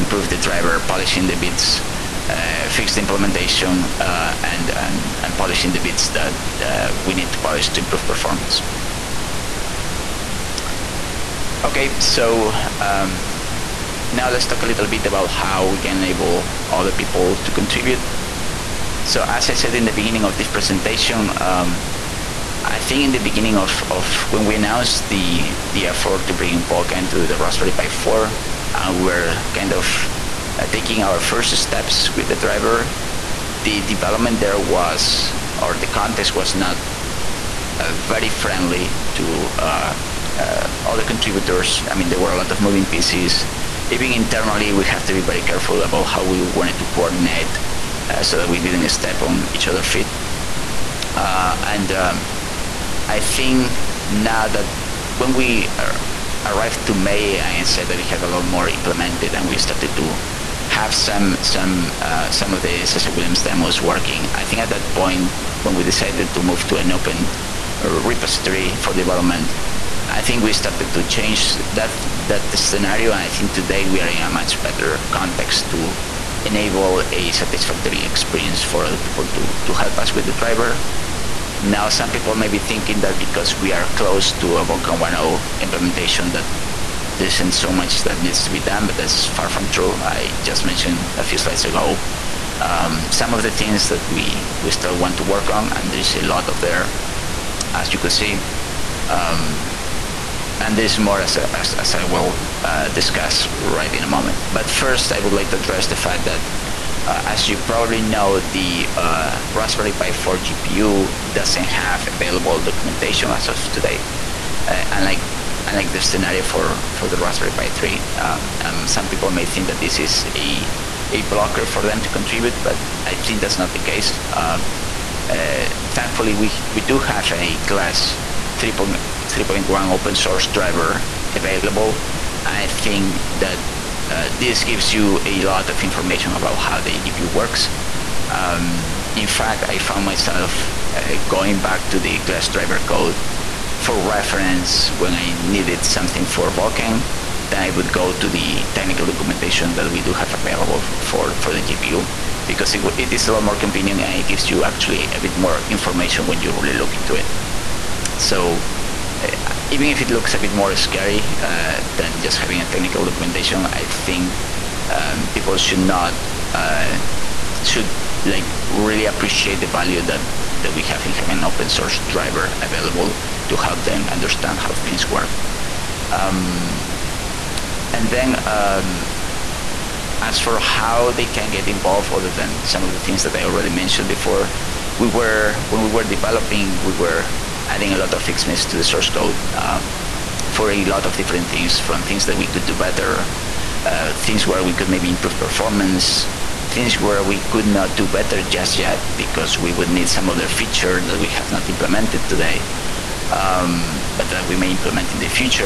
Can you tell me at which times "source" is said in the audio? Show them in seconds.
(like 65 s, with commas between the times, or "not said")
130 s, 171 s, 188 s.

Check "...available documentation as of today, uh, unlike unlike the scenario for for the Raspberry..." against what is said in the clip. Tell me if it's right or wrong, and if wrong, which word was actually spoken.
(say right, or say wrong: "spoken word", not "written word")
right.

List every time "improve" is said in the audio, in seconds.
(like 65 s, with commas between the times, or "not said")
7 s, 195 s.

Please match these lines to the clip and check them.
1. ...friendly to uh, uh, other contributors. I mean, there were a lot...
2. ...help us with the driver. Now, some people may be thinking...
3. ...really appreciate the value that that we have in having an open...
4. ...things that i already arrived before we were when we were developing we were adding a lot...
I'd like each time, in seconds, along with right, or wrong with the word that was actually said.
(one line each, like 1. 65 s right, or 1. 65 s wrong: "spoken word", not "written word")
1. 38 s right
2. 79 s right
3. 168 s right
4. 183 s wrong: "mentioned", not "arrived".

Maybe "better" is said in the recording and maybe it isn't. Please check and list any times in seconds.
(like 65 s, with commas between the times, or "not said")
74 s, 192 s, 198 s.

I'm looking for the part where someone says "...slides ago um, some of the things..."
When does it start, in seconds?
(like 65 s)
91 s.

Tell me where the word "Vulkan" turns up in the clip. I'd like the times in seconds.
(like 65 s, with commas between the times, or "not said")
26 s, 84 s, 146 s.